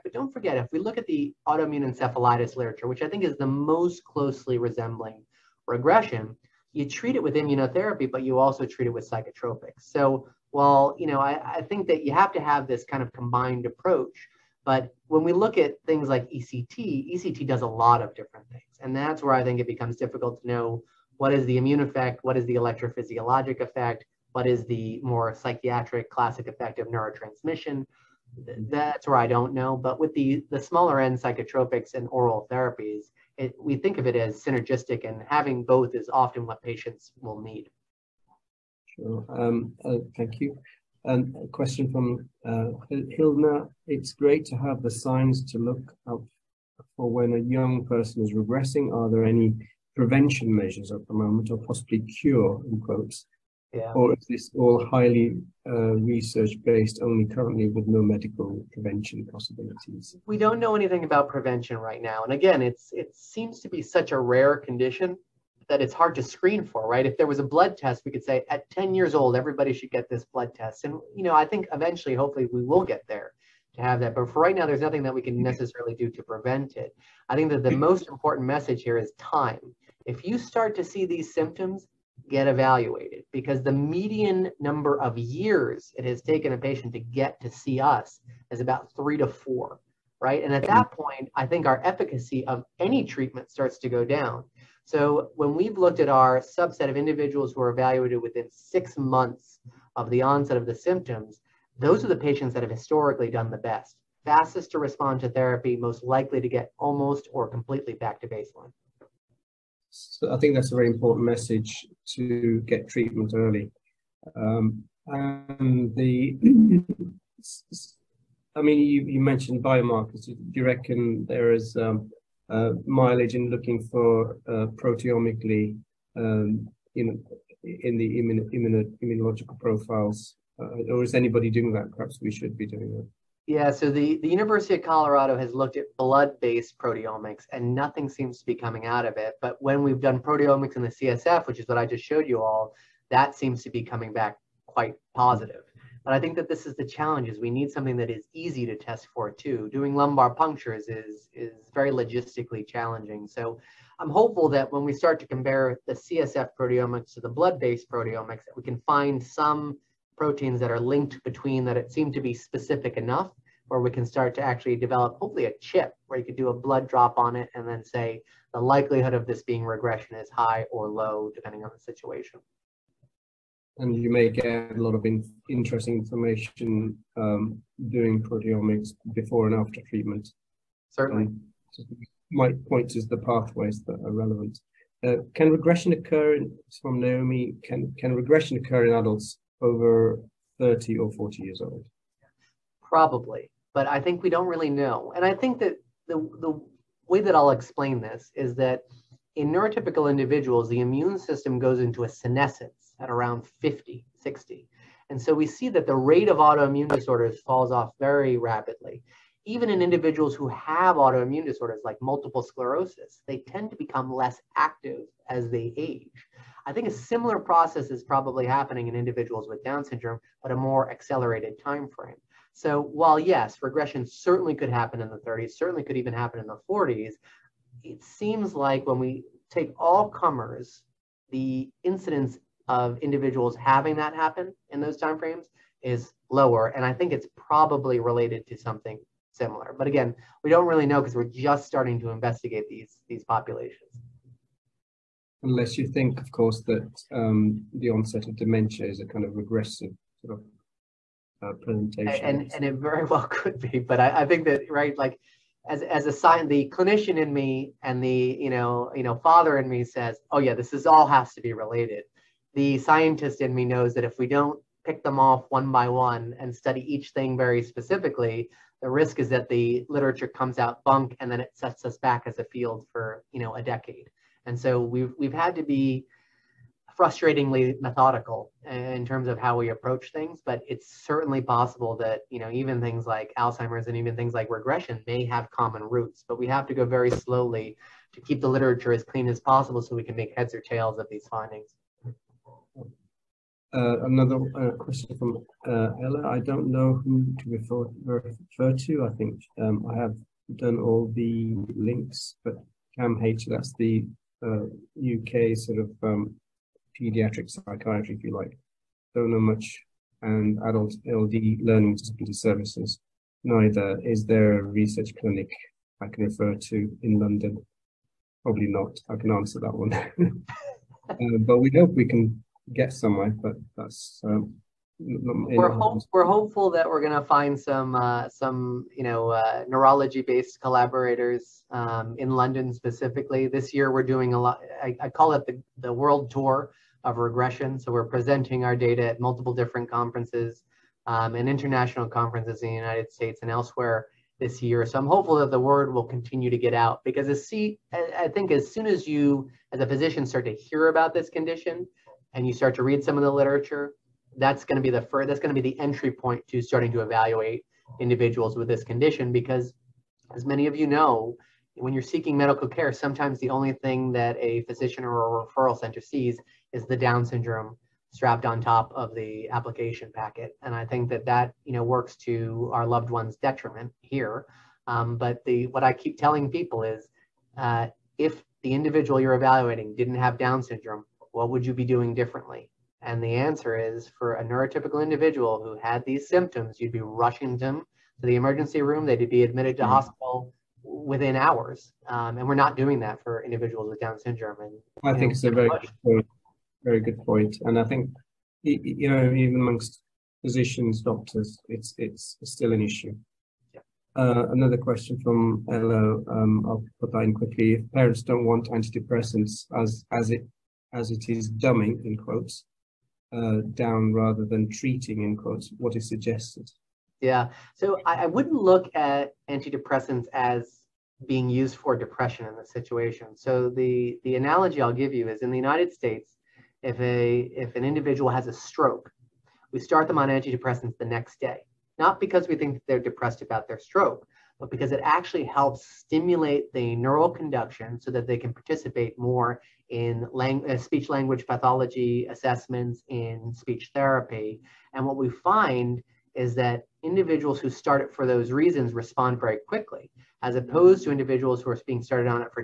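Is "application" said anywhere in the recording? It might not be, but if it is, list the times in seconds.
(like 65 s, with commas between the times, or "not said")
369 s.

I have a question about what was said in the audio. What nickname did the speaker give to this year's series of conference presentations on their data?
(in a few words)
World tour of regression.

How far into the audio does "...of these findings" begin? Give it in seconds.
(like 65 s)
290 s.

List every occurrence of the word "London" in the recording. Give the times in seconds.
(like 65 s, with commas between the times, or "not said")
317 s, 332 s.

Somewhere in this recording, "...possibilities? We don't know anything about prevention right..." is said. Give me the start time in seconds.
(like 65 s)
59 s.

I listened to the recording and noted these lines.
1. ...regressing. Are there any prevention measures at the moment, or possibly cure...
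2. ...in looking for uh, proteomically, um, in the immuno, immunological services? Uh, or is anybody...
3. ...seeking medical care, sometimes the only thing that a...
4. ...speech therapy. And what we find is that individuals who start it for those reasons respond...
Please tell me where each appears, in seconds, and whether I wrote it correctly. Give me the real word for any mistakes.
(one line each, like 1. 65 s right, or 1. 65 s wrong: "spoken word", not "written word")
1. 48 s right
2. 123 s wrong: "profiles", not "services"
3. 362 s right
4. 443 s right.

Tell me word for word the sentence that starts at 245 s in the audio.
Unless you think, of course, that um, the onset of dementia is a kind of regressive sort of uh, presentation.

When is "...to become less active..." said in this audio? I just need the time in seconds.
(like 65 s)
213 s.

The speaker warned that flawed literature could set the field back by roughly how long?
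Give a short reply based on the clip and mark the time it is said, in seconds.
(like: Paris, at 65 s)
A decade, at 273 s.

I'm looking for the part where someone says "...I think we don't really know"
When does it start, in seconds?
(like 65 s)
193 s.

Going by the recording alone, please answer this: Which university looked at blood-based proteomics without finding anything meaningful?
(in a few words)
University of Colorado.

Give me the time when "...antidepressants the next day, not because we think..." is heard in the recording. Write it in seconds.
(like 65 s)
430 s.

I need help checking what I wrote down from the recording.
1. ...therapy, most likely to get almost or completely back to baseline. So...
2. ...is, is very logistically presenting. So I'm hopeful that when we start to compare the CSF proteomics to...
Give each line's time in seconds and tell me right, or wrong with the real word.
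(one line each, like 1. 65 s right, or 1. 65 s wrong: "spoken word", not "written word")
1. 105 s right
2. 150 s wrong: "challenging", not "presenting".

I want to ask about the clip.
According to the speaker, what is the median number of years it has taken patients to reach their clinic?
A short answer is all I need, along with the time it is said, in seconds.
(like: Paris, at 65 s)
3 to 4, at 88 s.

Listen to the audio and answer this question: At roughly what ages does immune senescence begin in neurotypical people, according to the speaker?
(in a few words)
50 to 60.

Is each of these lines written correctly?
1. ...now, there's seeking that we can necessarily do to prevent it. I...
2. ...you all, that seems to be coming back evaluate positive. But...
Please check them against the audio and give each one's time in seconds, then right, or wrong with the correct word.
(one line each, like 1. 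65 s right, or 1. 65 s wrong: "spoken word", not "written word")
1. 74 s wrong: "nothing", not "seeking"
2. 142 s wrong: "quite", not "evaluate".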